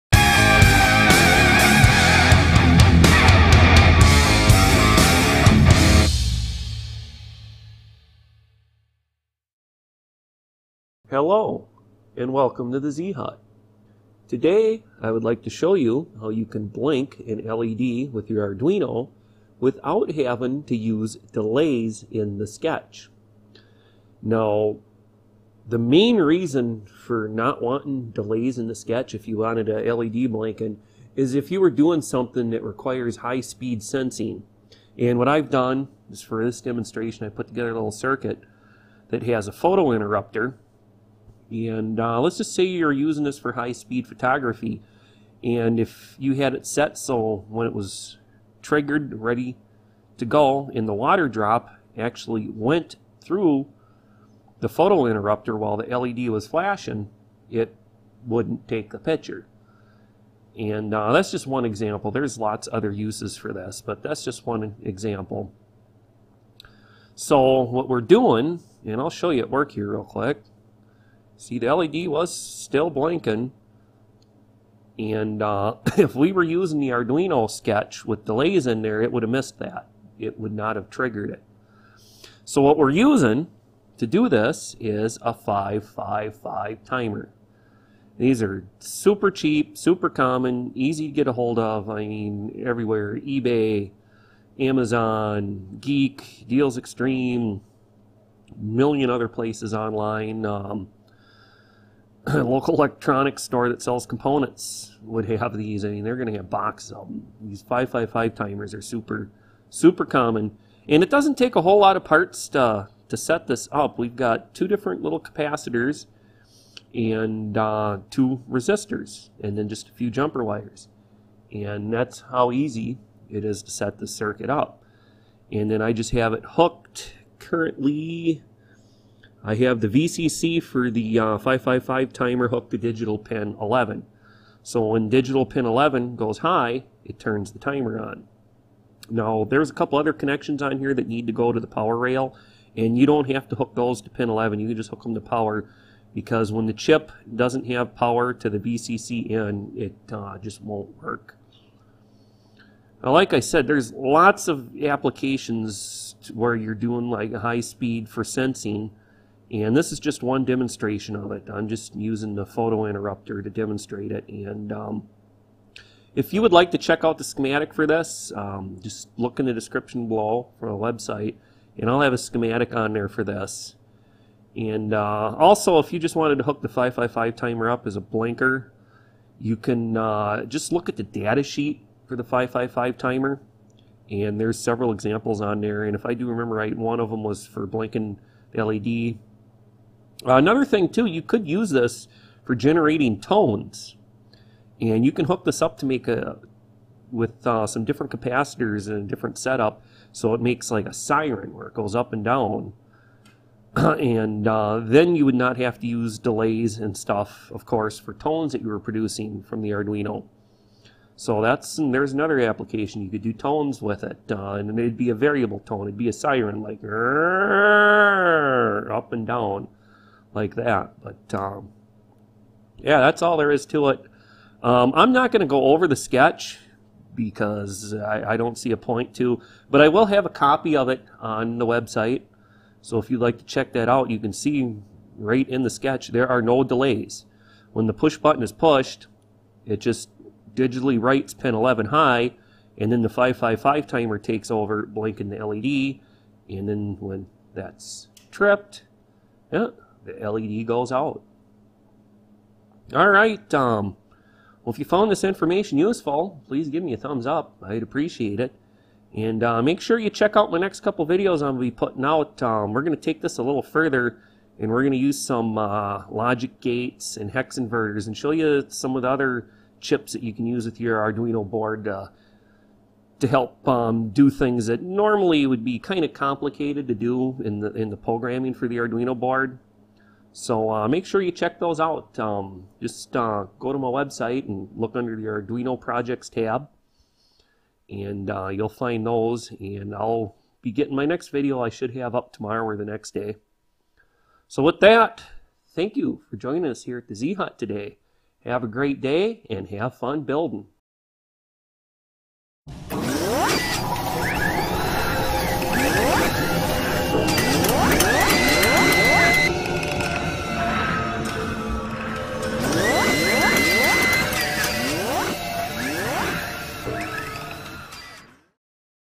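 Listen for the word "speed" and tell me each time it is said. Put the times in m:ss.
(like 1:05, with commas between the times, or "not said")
0:33, 0:43, 2:37.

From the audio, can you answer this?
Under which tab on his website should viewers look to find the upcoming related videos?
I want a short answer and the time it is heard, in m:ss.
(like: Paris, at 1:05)
Arduino Projects, at 4:45.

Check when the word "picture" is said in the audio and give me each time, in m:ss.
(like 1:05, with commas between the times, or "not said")
0:58.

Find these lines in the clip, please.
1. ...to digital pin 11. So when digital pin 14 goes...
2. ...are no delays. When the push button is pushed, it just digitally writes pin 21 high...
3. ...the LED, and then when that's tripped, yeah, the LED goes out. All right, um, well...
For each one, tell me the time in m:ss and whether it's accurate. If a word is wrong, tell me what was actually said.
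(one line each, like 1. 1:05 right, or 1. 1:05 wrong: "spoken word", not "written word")
1. 2:12 wrong: "11", not "14"
2. 3:56 wrong: "11", not "21"
3. 4:05 right.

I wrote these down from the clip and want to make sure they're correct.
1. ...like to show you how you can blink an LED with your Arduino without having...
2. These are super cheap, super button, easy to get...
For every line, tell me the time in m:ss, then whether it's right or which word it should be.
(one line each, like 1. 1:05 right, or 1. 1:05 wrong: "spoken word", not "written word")
1. 0:15 right
2. 1:28 wrong: "common", not "button".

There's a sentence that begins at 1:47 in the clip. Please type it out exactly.
These 555 timers are super, super common.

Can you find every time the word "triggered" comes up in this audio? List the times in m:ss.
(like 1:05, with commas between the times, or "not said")
0:48, 1:20.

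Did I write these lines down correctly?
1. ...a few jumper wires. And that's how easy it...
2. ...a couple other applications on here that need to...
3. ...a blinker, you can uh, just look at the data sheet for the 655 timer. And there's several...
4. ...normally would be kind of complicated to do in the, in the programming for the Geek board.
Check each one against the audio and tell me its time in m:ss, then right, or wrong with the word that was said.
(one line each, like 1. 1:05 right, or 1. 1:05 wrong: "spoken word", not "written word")
1. 1:59 right
2. 2:19 wrong: "connections", not "applications"
3. 2:57 wrong: "555", not "655"
4. 4:34 wrong: "Arduino", not "Geek".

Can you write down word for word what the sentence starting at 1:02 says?
There's lots other uses for this, but that's just one example.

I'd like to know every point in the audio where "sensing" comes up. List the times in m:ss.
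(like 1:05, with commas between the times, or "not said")
0:33, 2:38.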